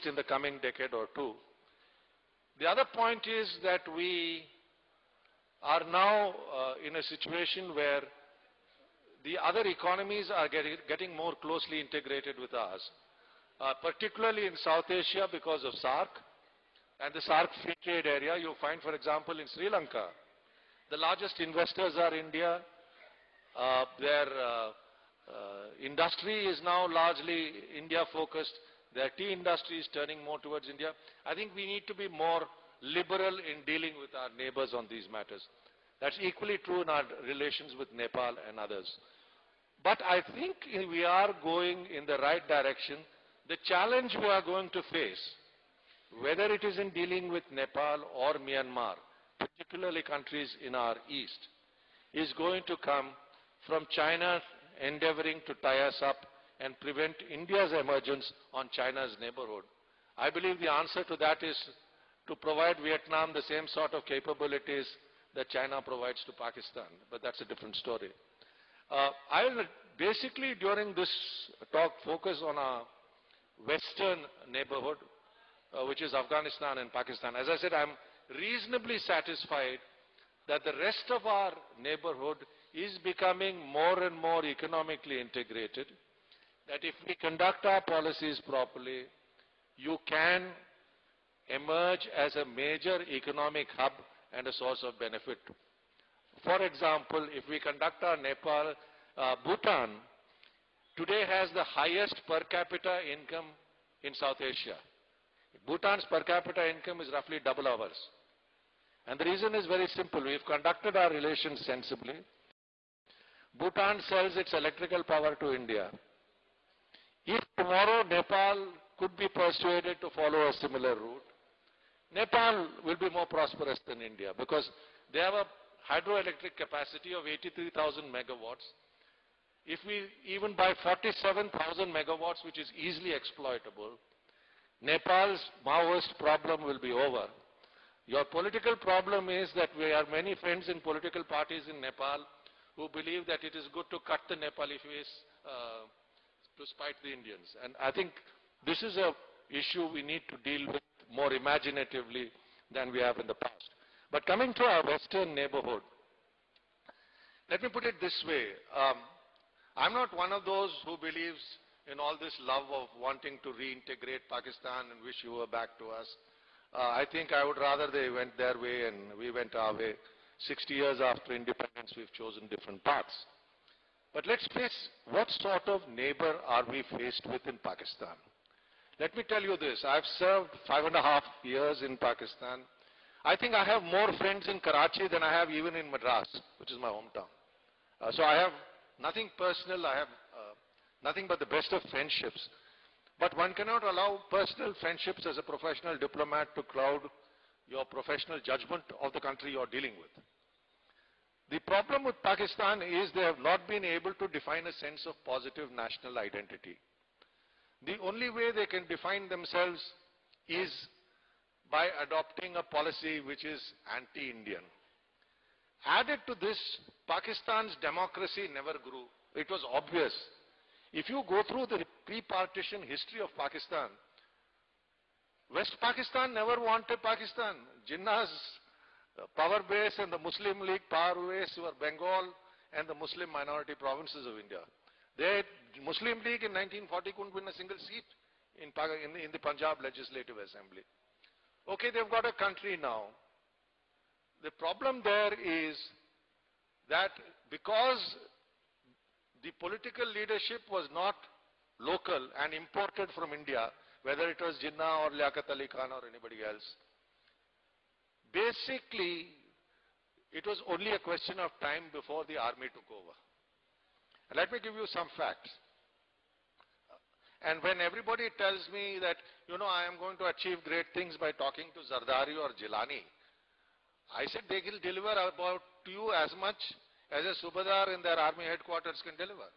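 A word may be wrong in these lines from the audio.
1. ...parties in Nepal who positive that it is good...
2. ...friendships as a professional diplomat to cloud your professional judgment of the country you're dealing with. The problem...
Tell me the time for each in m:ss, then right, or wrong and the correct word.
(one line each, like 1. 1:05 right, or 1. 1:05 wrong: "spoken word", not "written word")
1. 2:21 wrong: "believe", not "positive"
2. 3:14 right.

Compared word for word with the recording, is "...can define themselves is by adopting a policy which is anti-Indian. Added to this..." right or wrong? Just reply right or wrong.
right.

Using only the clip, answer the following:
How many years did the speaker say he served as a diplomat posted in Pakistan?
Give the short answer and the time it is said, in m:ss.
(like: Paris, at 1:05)
5.5 years, at 3:00.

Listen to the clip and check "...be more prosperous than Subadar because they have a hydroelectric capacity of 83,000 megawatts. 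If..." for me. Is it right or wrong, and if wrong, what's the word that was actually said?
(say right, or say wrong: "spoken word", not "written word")
wrong: "India", not "Subadar".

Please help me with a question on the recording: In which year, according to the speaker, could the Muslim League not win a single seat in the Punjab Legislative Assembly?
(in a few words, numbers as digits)
1940.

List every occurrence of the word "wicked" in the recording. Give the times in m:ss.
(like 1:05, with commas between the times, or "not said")
not said.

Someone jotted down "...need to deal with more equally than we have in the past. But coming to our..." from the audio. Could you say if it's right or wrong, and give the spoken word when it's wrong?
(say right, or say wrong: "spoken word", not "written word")
wrong: "imaginatively", not "equally".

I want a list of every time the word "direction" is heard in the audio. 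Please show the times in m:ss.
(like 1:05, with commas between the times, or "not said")
0:42.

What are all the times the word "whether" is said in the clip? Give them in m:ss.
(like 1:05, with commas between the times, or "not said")
0:46, 4:14.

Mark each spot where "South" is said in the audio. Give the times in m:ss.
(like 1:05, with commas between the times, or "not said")
0:14, 1:44.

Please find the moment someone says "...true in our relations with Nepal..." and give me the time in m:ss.
0:36.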